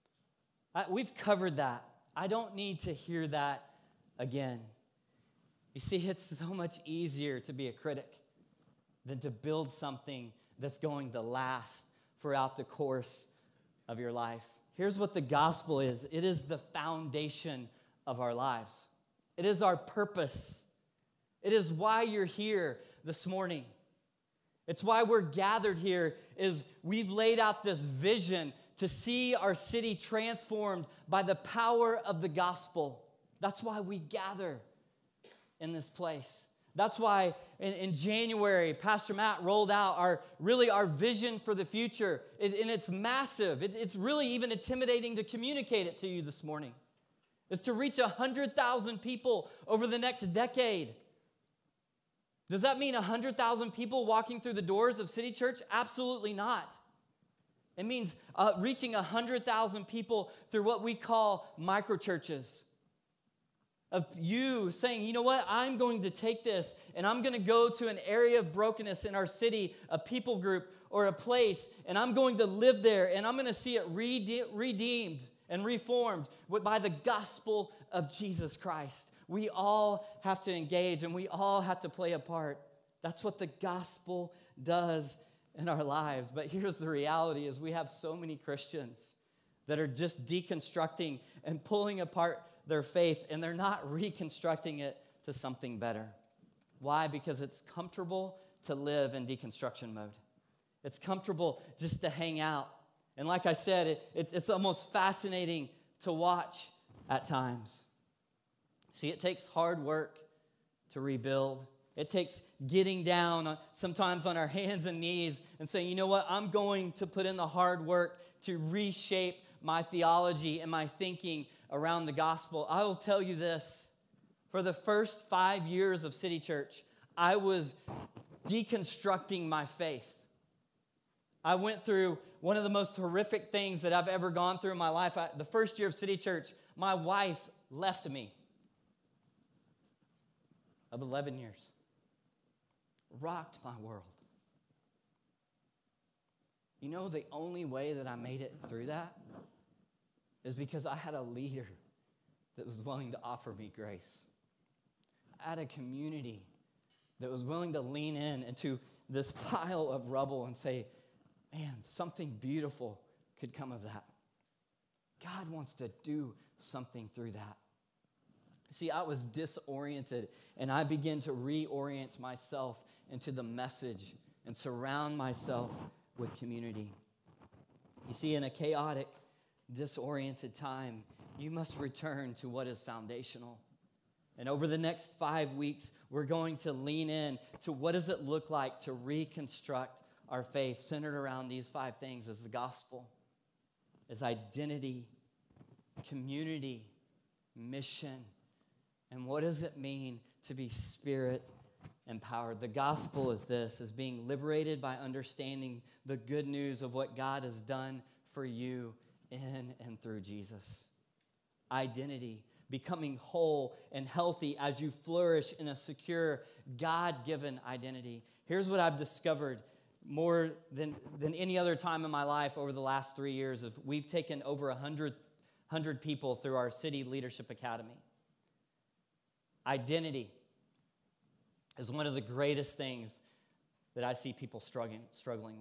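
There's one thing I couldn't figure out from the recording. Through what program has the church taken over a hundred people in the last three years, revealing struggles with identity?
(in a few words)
City Leadership Academy.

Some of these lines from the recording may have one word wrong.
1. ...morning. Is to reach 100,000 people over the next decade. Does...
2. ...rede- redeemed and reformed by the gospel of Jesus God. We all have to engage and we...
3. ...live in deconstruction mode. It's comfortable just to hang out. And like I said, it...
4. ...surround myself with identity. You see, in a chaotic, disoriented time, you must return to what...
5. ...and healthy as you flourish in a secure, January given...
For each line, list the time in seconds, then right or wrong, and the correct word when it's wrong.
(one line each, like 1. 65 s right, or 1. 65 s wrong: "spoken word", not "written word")
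1. 46 s right
2. 73 s wrong: "Christ", not "God"
3. 98 s right
4. 174 s wrong: "community", not "identity"
5. 213 s wrong: "God", not "January".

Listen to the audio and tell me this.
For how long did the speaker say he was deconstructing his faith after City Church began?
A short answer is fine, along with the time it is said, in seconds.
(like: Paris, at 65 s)
5 years, at 125 s.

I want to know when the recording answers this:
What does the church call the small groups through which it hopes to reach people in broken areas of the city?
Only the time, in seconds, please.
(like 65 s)
61 s.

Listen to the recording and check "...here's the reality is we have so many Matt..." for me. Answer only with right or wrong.
wrong.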